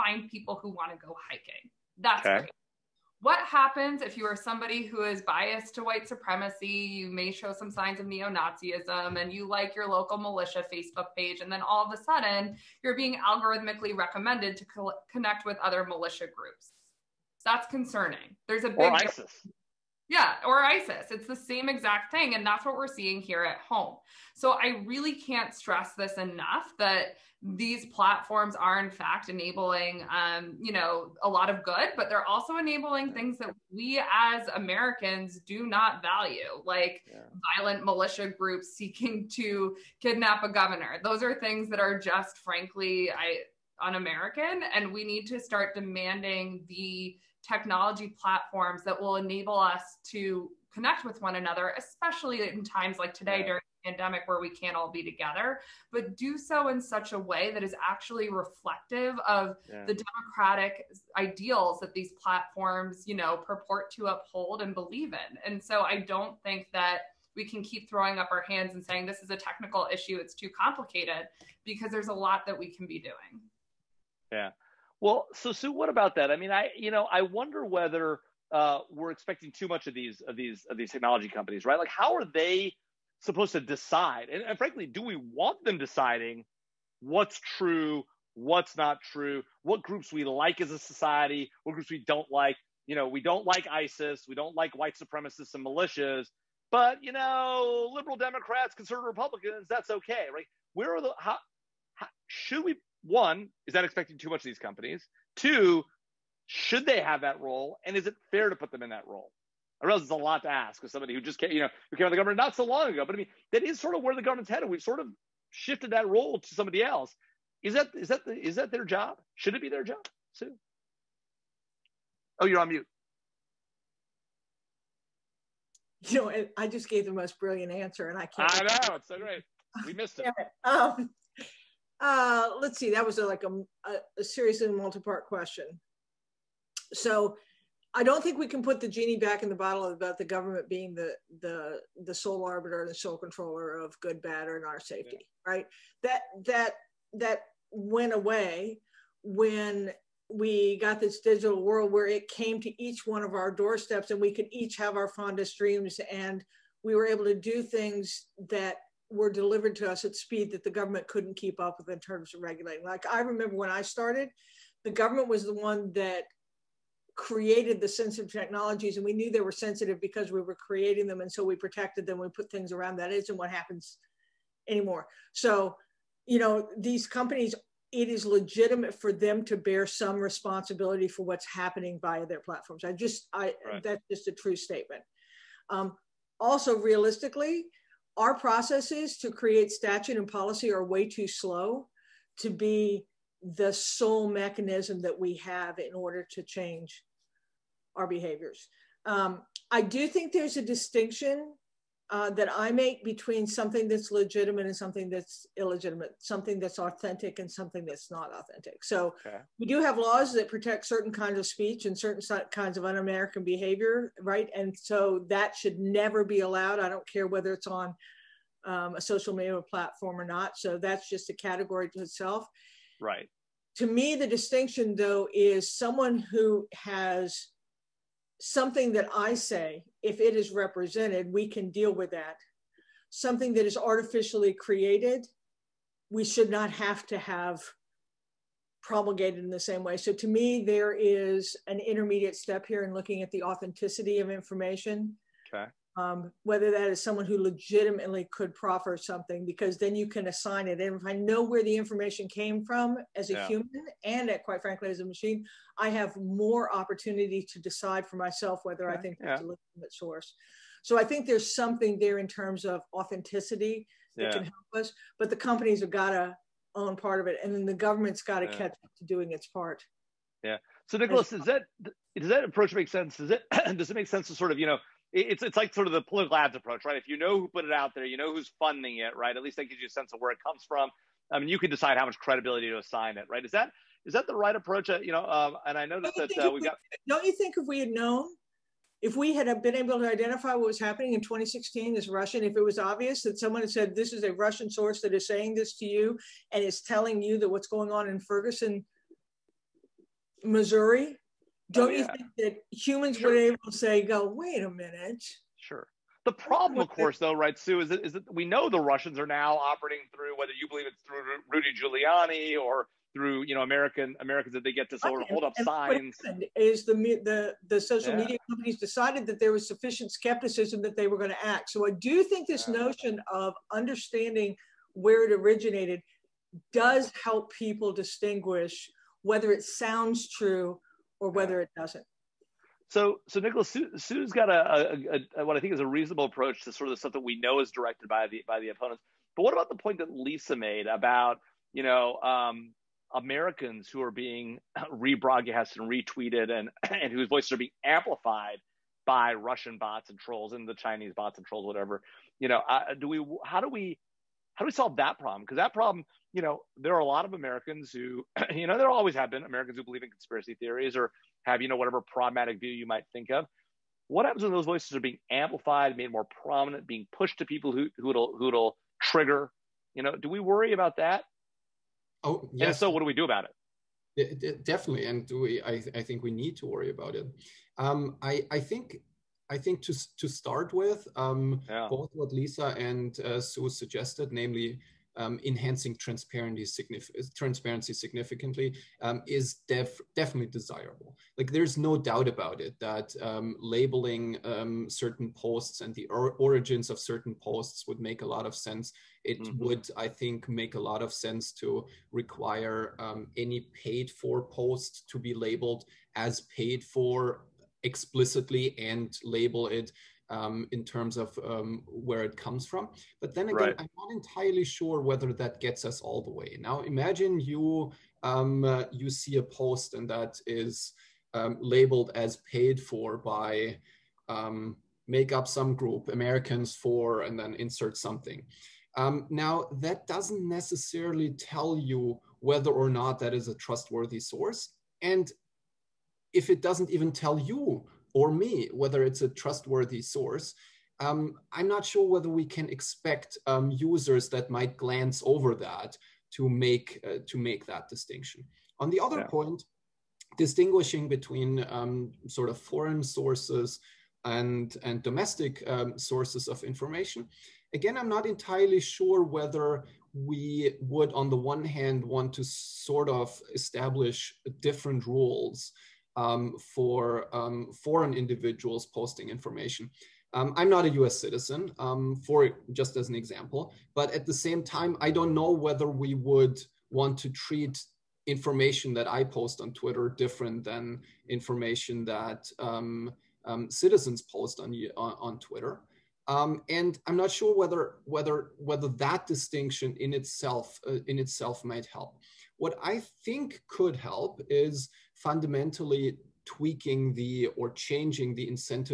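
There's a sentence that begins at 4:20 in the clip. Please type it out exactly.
So I think there's something there in terms of authenticity that yeah.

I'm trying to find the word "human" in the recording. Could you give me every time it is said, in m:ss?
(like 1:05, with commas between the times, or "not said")
4:13, 5:02.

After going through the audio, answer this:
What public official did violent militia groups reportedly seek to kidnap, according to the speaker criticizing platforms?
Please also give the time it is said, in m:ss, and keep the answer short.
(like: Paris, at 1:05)
a governor, at 0:40.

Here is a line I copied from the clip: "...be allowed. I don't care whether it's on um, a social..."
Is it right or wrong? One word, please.
right.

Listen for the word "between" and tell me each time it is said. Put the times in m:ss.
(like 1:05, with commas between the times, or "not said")
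3:23, 7:31.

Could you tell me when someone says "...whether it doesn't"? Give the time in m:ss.
5:31.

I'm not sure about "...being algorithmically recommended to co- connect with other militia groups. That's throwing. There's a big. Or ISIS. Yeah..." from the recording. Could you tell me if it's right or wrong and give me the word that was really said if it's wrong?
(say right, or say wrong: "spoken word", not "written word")
wrong: "concerning", not "throwing".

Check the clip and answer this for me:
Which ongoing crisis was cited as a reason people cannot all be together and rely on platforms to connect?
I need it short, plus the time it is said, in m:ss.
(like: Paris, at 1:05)
the pandemic, at 0:53.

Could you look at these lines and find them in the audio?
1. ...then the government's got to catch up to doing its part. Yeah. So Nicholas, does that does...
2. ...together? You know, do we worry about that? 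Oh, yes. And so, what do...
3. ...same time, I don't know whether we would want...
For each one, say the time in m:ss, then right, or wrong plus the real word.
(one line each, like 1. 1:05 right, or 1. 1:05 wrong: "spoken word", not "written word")
1. 4:27 right
2. 6:08 wrong: "trigger", not "together"
3. 7:54 right.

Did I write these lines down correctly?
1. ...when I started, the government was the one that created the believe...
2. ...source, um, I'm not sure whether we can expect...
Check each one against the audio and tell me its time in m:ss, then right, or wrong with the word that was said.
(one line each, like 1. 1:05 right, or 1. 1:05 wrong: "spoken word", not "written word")
1. 2:43 wrong: "sensitive", not "believe"
2. 7:20 right.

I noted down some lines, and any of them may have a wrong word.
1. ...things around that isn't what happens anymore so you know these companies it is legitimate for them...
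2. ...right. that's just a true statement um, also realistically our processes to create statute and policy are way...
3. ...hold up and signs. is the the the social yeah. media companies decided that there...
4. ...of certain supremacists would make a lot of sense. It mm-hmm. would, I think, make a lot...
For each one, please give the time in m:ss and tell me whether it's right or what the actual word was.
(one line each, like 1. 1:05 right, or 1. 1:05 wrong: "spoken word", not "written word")
1. 2:52 right
2. 3:03 right
3. 5:15 right
4. 6:36 wrong: "posts", not "supremacists".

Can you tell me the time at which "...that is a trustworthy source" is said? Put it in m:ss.
7:13.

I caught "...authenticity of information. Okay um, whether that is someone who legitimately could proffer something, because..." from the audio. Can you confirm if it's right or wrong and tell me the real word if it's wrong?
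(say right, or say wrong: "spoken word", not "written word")
right.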